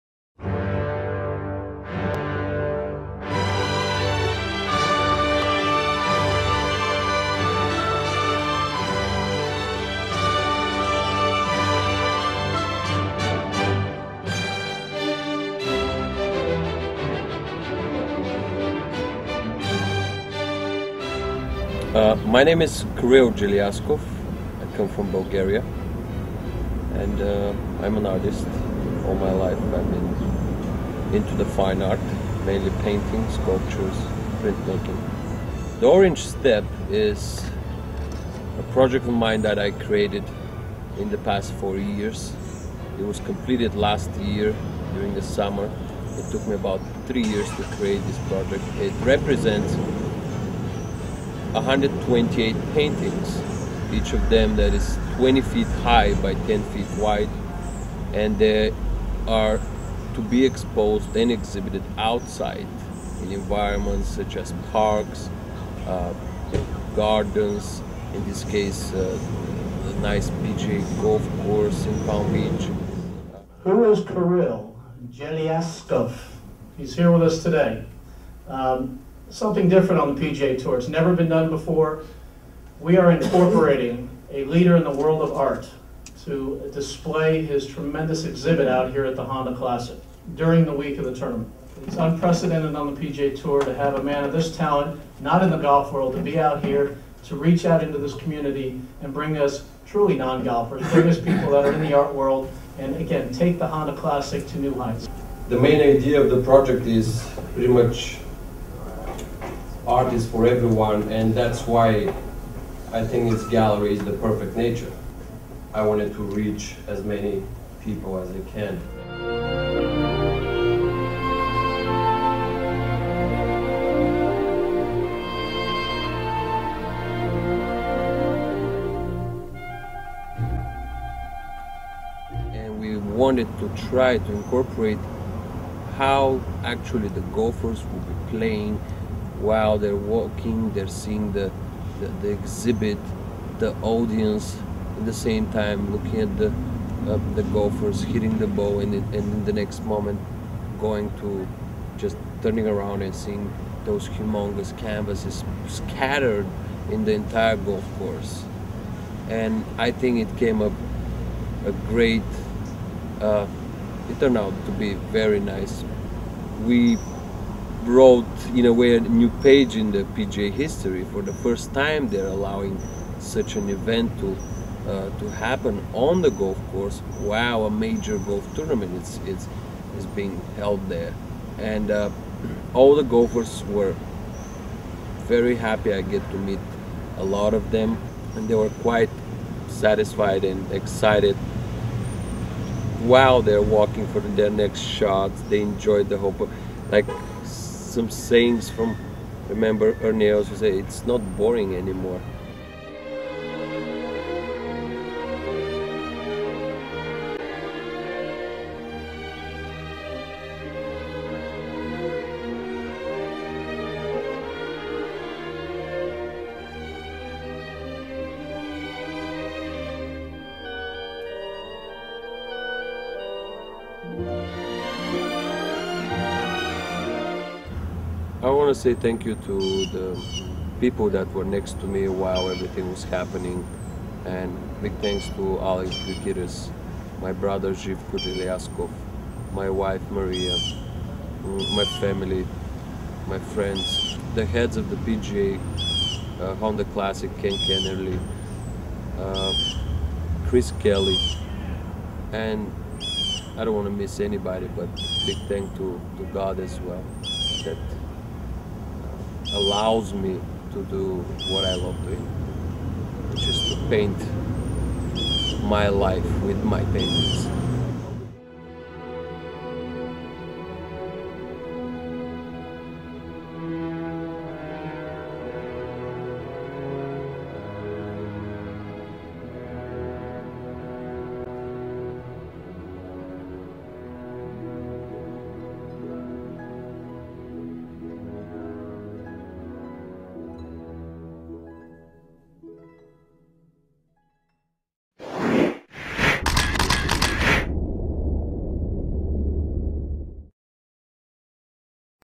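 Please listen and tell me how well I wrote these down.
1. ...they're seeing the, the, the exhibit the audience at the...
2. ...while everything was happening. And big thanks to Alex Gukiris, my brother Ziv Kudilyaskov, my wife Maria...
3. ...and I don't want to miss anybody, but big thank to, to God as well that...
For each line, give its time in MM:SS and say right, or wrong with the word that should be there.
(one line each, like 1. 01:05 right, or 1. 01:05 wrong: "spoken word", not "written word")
1. 02:20 right
2. 03:52 right
3. 04:12 right.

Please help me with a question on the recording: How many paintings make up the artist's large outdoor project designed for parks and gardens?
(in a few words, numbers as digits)
128.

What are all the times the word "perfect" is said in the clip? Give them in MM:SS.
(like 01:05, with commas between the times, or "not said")
01:54.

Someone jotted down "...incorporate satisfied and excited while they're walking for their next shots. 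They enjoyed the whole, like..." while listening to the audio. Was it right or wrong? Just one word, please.
wrong.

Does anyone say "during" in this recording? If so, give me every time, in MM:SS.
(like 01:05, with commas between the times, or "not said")
00:44, 01:30.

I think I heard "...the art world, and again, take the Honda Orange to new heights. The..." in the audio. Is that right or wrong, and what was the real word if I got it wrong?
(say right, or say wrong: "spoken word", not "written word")
wrong: "Classic", not "Orange".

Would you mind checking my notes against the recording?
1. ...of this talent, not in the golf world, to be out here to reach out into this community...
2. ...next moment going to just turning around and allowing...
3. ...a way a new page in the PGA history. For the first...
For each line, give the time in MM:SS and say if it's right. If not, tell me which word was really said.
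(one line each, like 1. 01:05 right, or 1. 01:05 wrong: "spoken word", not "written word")
1. 01:34 right
2. 02:29 wrong: "seeing", not "allowing"
3. 02:48 right.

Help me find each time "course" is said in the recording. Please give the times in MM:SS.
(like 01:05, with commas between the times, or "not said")
01:11, 02:37, 02:56.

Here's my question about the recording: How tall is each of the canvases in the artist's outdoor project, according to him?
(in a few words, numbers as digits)
20 feet.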